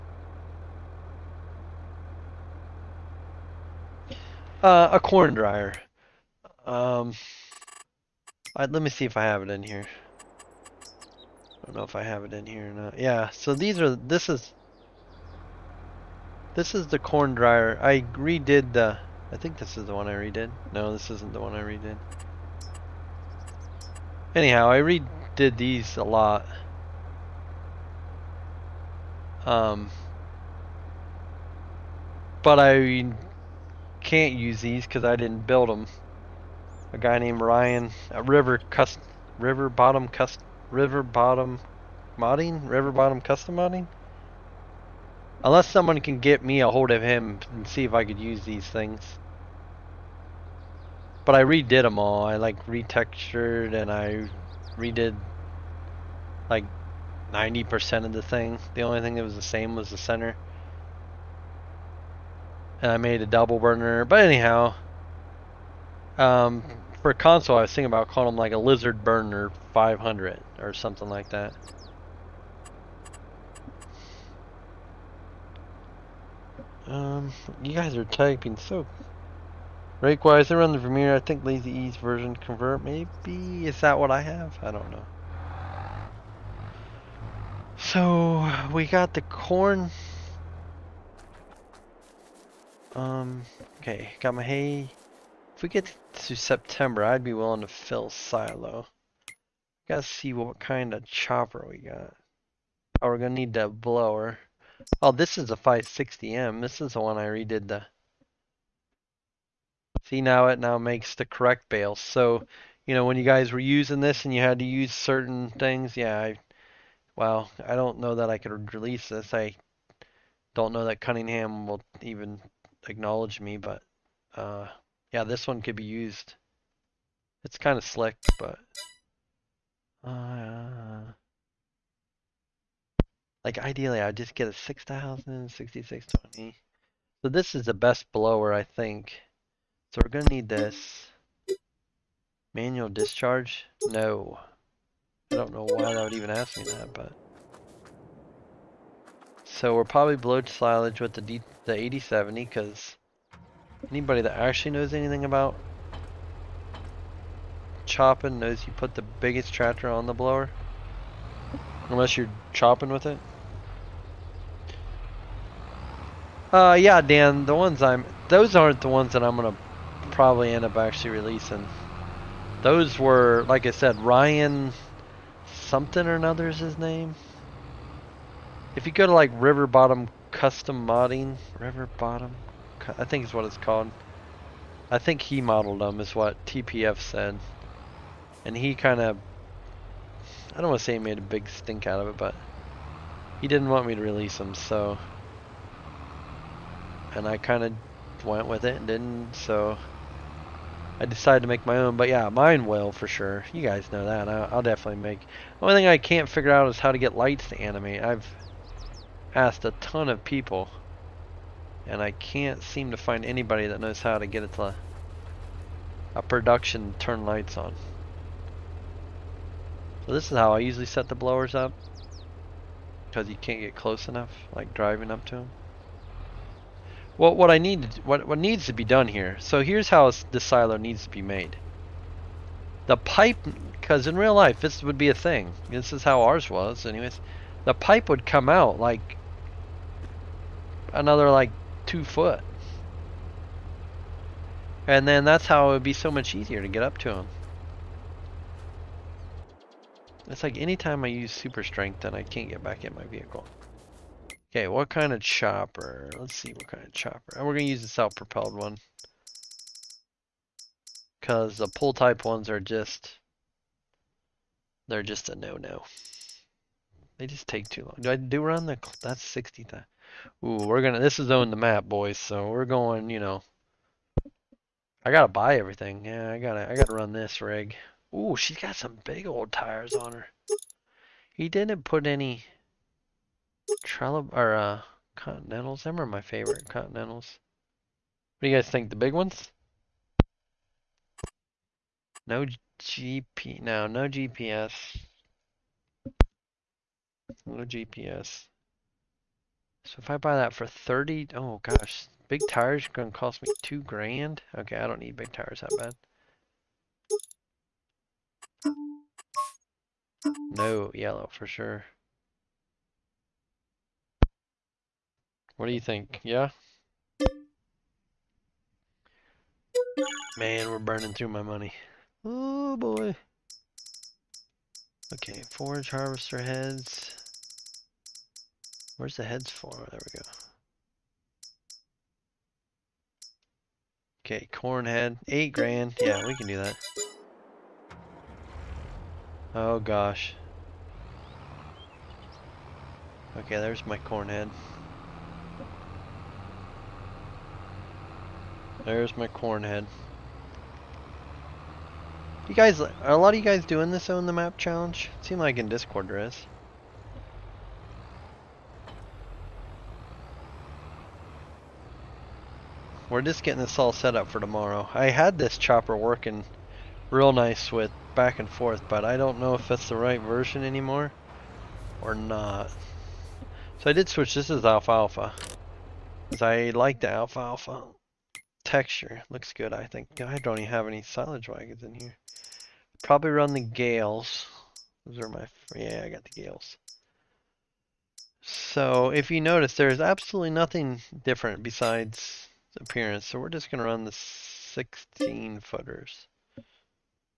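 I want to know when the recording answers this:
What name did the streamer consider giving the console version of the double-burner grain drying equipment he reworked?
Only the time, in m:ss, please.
1:08.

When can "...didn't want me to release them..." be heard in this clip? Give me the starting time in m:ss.
3:13.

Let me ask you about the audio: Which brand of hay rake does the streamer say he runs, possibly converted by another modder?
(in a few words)
Vermeer.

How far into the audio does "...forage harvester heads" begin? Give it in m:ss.
5:25.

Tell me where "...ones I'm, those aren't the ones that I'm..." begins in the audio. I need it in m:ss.
2:47.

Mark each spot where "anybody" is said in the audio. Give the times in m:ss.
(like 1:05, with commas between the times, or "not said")
2:33, 3:33.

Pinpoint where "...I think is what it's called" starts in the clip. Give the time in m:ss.
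3:02.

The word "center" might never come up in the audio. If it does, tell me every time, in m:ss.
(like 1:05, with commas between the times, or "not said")
0:59.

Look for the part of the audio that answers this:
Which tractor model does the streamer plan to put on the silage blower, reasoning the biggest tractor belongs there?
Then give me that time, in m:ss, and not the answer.
2:31.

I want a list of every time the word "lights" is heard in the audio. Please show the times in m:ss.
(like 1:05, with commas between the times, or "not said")
3:27, 3:37.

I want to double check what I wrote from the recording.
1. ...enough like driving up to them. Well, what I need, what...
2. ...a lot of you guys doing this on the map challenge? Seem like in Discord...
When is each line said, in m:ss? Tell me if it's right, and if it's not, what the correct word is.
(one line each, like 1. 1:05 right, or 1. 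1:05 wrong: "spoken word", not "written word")
1. 3:44 right
2. 5:53 right.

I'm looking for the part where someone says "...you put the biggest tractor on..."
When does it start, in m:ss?
2:38.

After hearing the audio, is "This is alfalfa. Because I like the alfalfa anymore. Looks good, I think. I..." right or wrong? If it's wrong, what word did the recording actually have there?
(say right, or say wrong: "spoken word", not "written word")
wrong: "texture", not "anymore".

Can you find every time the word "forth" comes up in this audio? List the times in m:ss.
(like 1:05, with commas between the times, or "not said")
6:08.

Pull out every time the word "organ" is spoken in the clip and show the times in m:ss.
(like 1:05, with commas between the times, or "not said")
not said.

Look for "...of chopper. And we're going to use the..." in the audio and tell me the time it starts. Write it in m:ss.
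4:16.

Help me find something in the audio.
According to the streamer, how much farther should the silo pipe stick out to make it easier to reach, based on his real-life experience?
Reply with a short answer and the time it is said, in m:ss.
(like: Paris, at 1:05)
2 feet, at 4:01.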